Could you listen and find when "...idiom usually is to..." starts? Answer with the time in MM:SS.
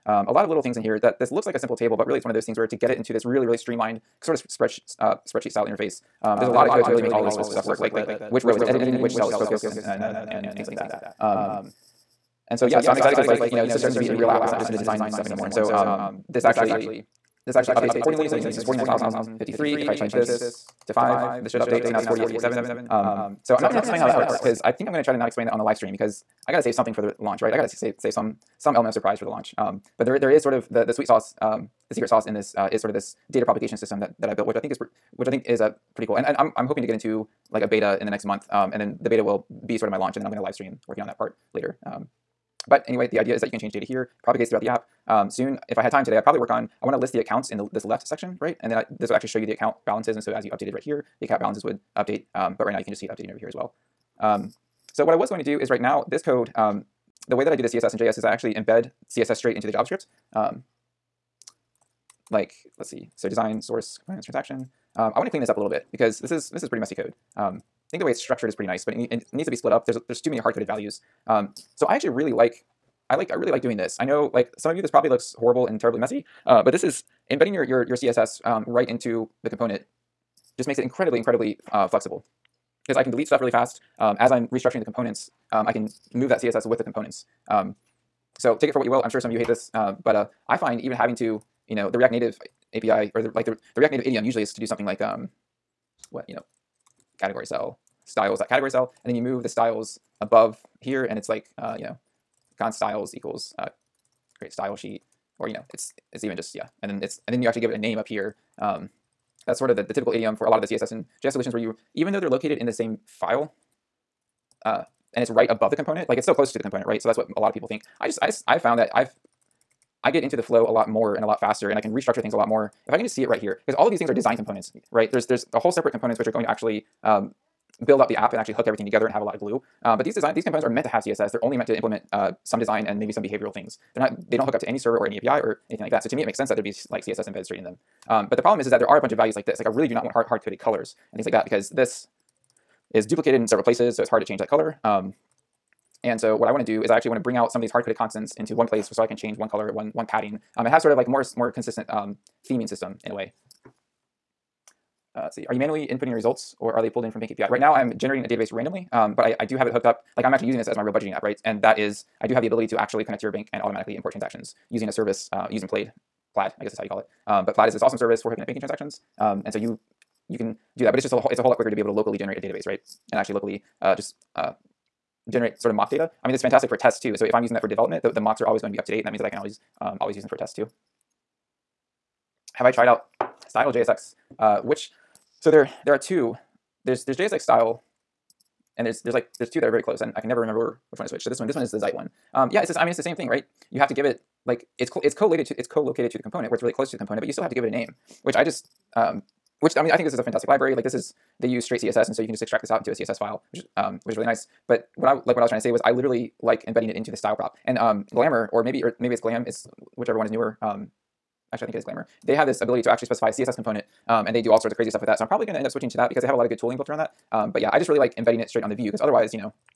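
01:34.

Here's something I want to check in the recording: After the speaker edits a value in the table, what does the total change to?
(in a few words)
4857.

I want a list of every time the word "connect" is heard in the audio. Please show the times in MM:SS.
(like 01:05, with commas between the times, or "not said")
02:43.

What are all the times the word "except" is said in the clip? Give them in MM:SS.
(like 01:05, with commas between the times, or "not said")
not said.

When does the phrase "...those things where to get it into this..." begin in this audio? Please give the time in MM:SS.
00:02.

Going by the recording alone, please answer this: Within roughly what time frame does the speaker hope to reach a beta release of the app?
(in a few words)
next month.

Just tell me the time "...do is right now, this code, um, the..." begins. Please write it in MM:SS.
00:55.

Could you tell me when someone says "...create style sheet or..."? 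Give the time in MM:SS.
01:44.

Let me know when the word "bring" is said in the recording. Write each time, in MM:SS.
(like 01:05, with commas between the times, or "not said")
02:27.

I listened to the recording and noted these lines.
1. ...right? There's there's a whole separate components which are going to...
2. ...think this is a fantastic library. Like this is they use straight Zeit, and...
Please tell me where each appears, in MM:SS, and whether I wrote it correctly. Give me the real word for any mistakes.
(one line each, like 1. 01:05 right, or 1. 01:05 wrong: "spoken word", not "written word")
1. 02:04 right
2. 03:19 wrong: "CSS", not "Zeit".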